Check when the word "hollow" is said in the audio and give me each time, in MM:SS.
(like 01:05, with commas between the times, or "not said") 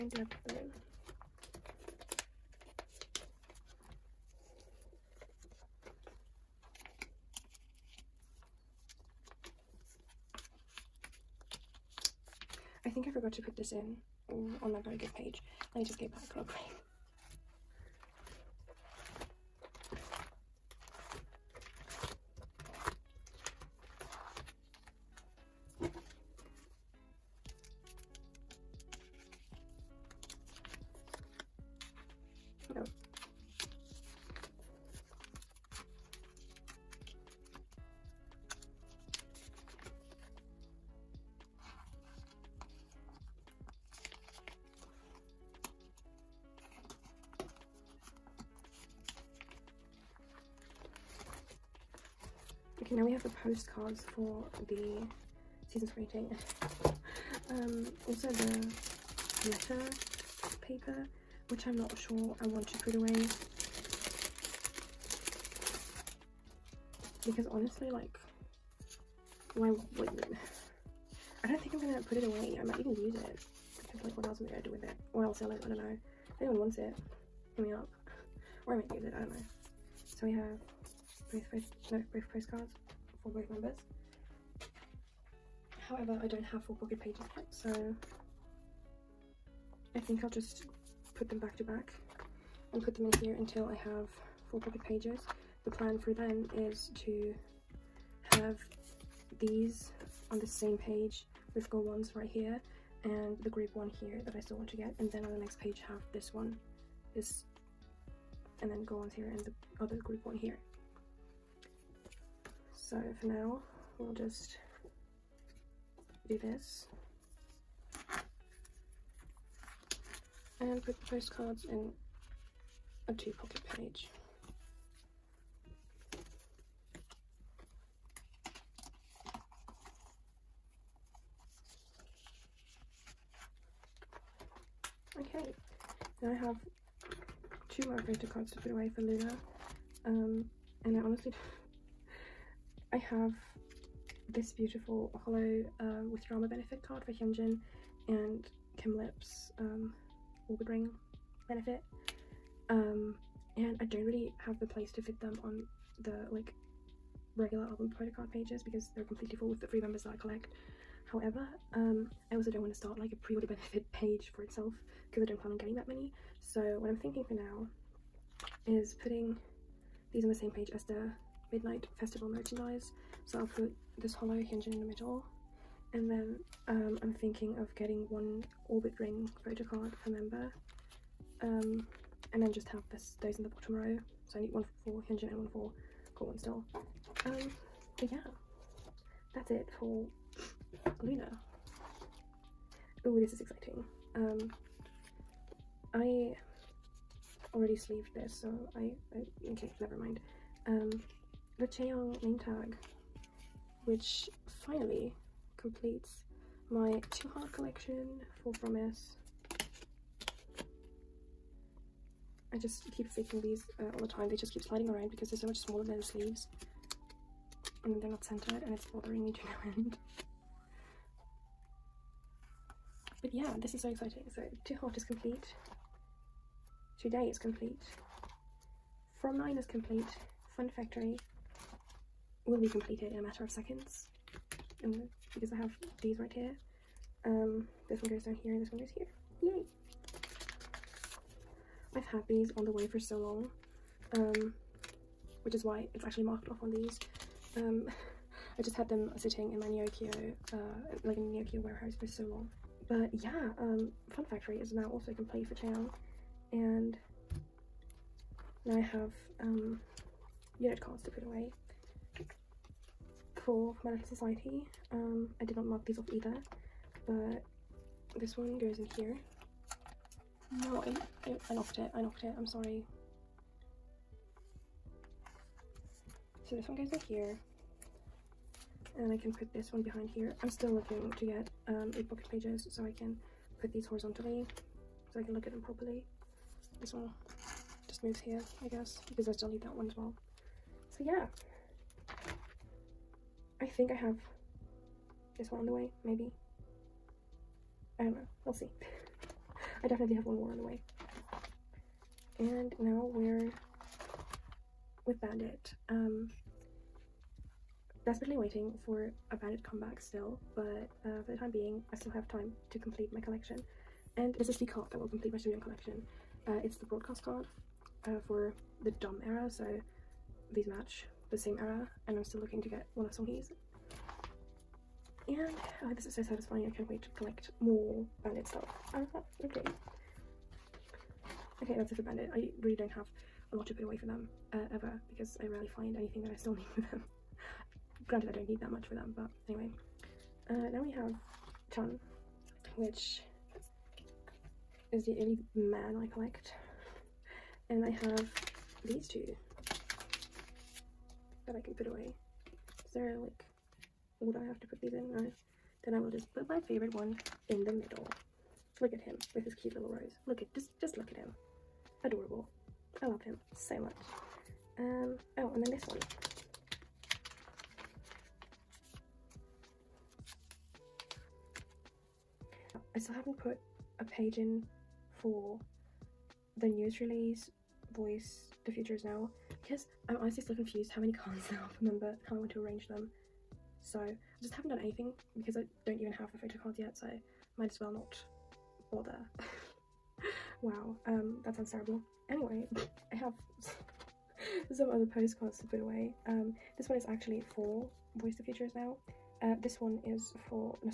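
02:25, 02:54.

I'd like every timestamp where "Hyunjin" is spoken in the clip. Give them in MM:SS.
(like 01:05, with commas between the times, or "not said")
02:27, 03:05.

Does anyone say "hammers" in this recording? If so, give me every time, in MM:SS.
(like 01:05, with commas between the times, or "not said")
not said.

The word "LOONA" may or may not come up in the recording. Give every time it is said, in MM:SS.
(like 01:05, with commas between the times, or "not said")
02:18, 03:11.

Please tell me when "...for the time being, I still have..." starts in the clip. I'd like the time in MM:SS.
05:11.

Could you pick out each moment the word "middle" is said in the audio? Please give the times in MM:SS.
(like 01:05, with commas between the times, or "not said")
02:54, 05:57.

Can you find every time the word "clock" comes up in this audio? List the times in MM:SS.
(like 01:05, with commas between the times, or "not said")
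not said.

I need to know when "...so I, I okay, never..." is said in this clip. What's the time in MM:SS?
03:18.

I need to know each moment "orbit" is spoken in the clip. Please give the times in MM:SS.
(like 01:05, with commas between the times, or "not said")
02:30, 02:58.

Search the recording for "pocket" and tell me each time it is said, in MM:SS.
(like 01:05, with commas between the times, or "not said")
01:26, 01:34, 02:03, 04:42.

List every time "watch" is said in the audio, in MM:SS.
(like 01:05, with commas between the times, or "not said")
not said.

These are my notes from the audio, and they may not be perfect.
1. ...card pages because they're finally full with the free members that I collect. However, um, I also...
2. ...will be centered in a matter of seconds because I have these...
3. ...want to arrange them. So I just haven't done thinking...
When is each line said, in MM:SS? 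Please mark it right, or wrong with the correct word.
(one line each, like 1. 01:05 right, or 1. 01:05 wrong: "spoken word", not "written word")
1. 02:38 wrong: "completely", not "finally"
2. 03:52 wrong: "completed", not "centered"
3. 06:22 wrong: "anything", not "thinking".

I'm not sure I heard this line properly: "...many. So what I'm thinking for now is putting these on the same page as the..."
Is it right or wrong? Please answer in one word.
right.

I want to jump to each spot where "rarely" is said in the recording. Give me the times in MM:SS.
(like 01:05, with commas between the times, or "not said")
05:35.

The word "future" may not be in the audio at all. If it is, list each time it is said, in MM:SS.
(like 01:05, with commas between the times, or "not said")
06:18, 06:38.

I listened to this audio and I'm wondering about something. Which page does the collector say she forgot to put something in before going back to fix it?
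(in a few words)
Berry Good page.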